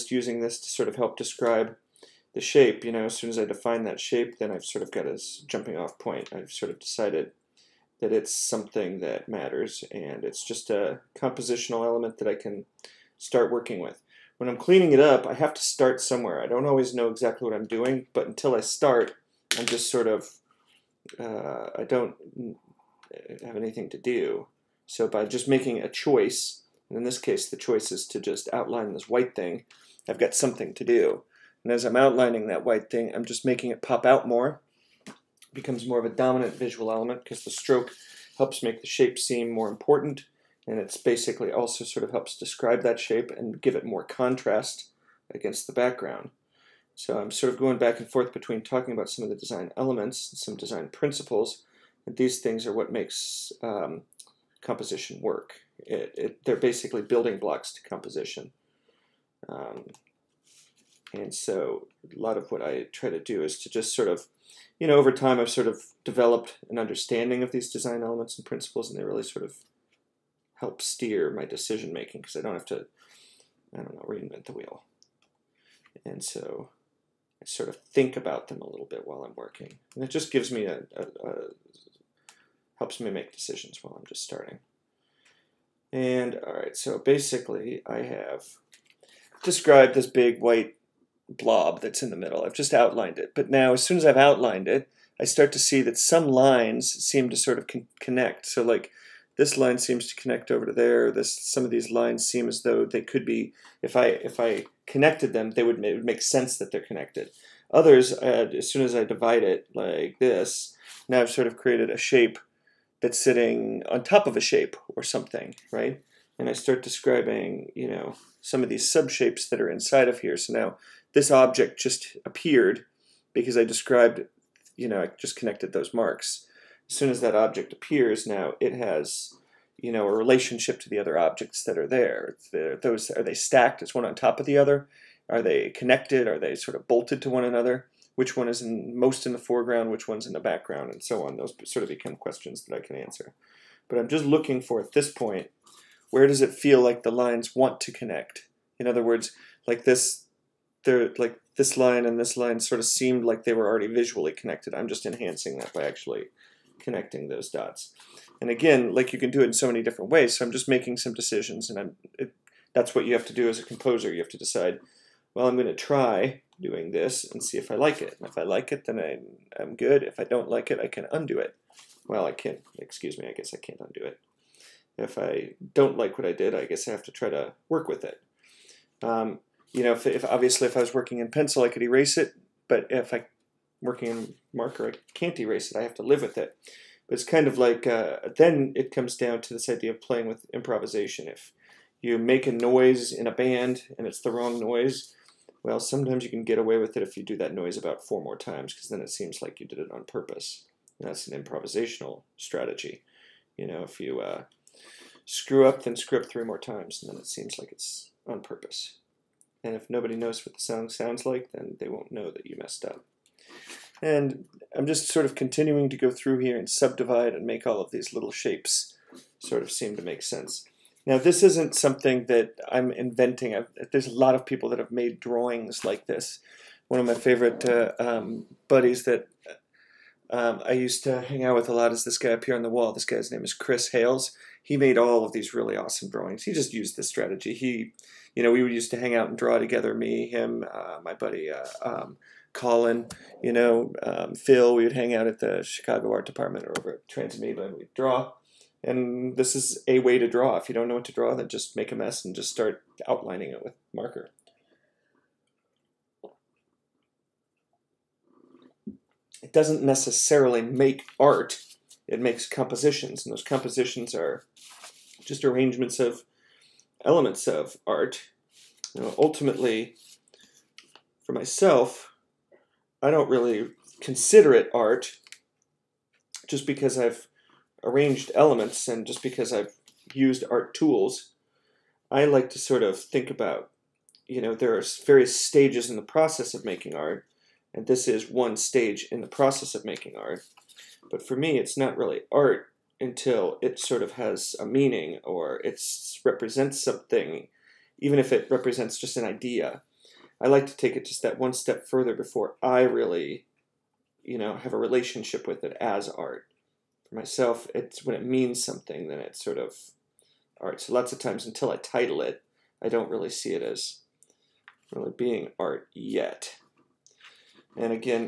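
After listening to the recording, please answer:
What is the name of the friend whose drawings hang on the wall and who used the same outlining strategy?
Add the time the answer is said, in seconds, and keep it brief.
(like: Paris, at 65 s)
Chris Hales, at 233 s.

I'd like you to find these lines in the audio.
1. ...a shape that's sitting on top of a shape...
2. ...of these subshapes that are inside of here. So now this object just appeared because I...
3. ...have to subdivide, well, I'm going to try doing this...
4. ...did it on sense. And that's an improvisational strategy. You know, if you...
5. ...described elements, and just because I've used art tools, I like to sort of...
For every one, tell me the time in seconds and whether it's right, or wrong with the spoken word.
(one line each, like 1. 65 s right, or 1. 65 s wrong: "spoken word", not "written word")
1. 111 s right
2. 118 s right
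3. 164 s wrong: "decide", not "subdivide"
4. 199 s wrong: "purpose", not "sense"
5. 277 s wrong: "arranged", not "described".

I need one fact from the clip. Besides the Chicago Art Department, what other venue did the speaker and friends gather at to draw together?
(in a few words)
Transamoeba.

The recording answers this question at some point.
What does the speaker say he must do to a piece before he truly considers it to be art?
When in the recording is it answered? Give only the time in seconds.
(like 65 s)
311 s.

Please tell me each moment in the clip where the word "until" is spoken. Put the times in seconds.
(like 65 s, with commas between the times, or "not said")
18 s, 292 s, 311 s.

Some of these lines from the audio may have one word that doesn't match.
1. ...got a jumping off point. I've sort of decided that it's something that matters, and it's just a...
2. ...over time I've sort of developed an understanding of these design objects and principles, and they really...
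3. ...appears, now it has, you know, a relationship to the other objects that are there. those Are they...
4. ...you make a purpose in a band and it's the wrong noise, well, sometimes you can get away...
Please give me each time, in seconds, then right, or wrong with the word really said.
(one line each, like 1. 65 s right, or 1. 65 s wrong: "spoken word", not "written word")
1. 4 s right
2. 64 s wrong: "elements", not "objects"
3. 127 s right
4. 192 s wrong: "noise", not "purpose".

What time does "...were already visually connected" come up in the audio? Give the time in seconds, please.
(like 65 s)
153 s.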